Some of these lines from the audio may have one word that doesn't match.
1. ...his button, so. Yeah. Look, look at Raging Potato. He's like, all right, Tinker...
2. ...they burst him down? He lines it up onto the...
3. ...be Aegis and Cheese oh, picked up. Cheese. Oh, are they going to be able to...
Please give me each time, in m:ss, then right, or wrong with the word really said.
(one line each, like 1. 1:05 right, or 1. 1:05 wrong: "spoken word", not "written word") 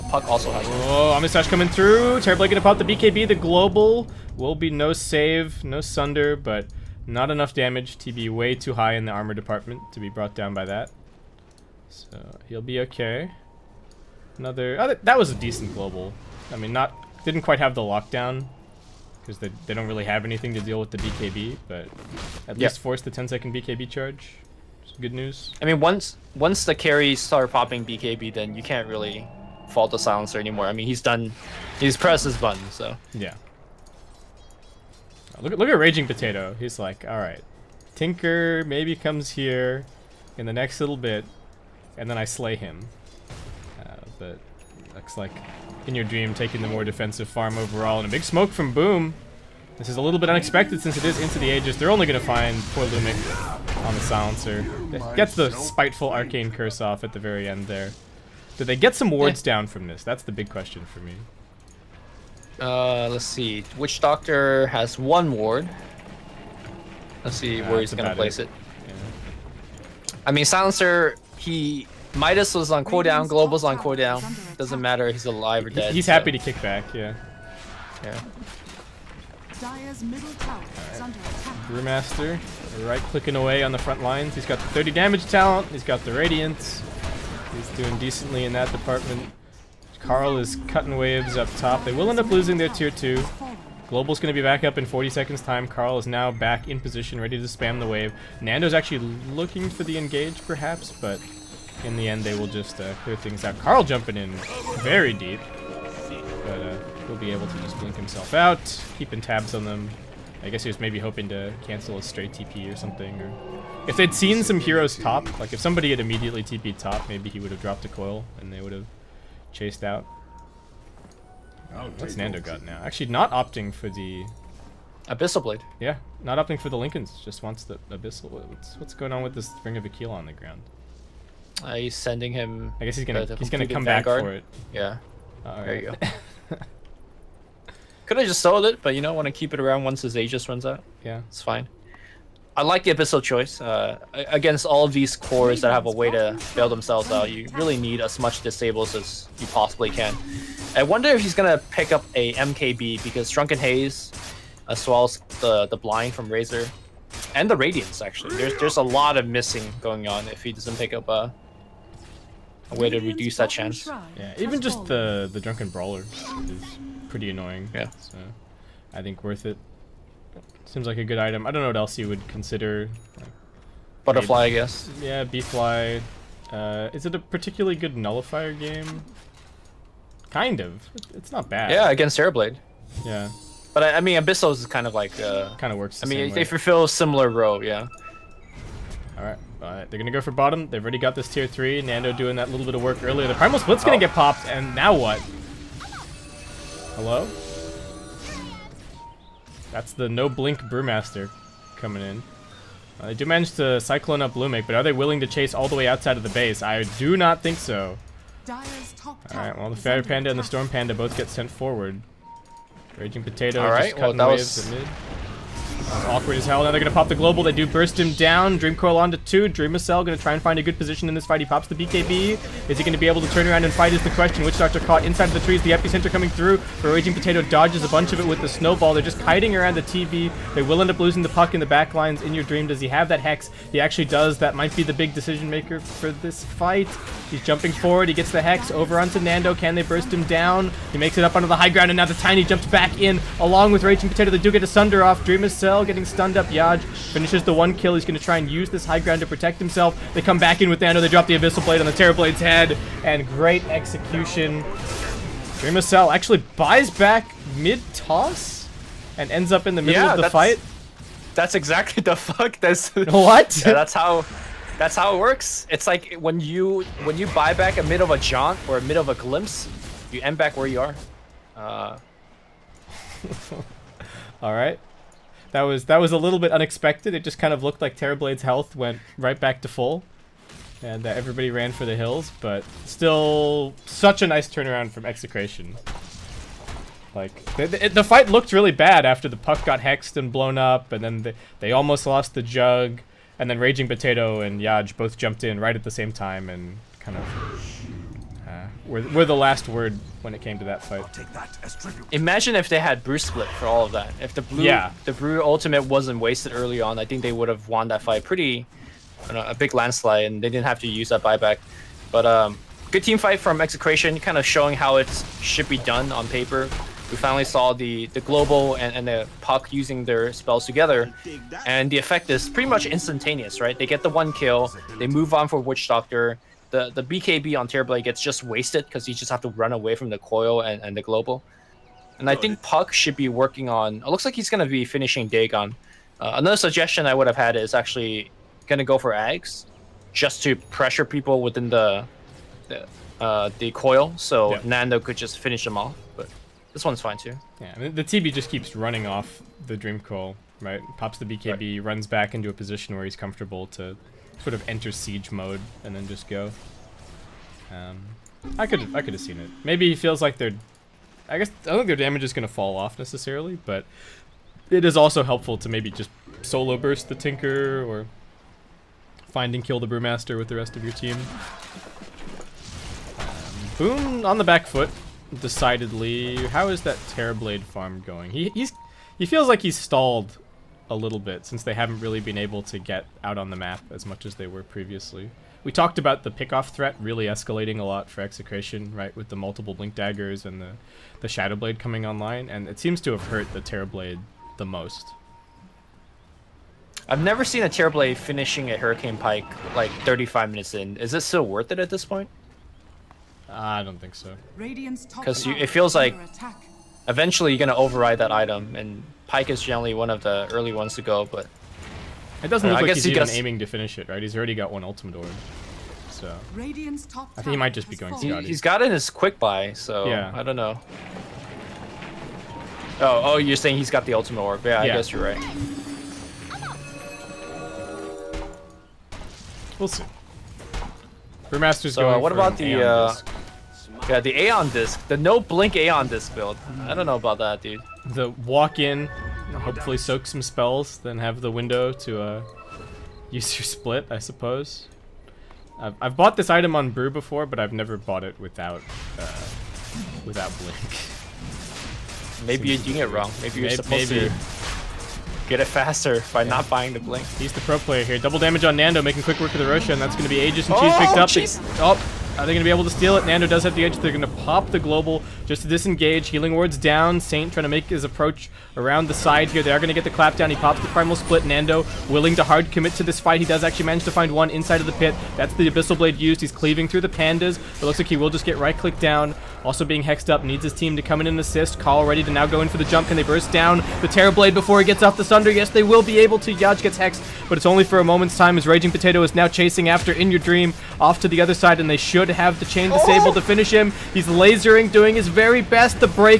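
1. 0:32 right
2. 3:59 wrong: "makes", not "lines"
3. 7:40 right.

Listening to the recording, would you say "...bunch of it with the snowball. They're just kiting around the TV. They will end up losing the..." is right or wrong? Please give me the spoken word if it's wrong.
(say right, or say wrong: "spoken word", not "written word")
right.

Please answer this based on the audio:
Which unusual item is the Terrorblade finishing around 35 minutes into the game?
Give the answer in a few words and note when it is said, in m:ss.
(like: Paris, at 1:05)
Hurricane Pike, at 6:38.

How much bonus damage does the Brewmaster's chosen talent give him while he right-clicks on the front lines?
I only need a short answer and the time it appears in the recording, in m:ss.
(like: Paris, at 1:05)
30, at 1:24.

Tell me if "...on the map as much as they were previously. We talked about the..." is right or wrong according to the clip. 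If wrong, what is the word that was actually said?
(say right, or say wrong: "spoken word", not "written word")
right.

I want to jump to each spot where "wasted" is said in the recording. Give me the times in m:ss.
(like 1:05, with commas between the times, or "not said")
5:06, 5:28.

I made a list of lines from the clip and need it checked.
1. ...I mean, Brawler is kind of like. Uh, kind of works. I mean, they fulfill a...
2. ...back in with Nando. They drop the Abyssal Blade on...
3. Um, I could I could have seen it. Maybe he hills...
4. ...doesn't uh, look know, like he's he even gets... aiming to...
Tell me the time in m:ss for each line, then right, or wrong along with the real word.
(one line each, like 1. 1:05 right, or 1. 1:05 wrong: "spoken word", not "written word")
1. 3:03 wrong: "Abyssos", not "Brawler"
2. 4:10 right
3. 5:57 wrong: "feels", not "hills"
4. 6:52 right.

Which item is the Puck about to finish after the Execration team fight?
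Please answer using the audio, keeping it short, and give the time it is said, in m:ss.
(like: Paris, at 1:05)
Dagon, at 5:35.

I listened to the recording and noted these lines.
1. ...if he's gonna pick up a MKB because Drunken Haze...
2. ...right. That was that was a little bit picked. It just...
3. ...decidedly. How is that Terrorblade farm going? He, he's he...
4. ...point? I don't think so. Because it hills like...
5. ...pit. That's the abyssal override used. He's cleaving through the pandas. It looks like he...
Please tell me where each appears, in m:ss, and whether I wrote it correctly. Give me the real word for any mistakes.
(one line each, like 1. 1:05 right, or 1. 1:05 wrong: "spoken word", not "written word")
1. 2:31 right
2. 4:34 wrong: "unexpected", not "picked"
3. 6:15 right
4. 6:42 wrong: "feels", not "hills"
5. 7:54 wrong: "blade", not "override".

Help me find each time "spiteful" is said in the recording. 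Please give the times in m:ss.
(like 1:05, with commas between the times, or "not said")
0:55.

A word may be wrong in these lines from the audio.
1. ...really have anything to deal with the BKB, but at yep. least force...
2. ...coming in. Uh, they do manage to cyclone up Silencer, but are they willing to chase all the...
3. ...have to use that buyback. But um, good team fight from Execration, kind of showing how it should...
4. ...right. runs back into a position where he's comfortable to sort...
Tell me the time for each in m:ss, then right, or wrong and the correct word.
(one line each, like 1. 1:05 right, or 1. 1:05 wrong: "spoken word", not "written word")
1. 0:19 right
2. 3:21 wrong: "Lumic", not "Silencer"
3. 5:10 right
4. 5:51 right.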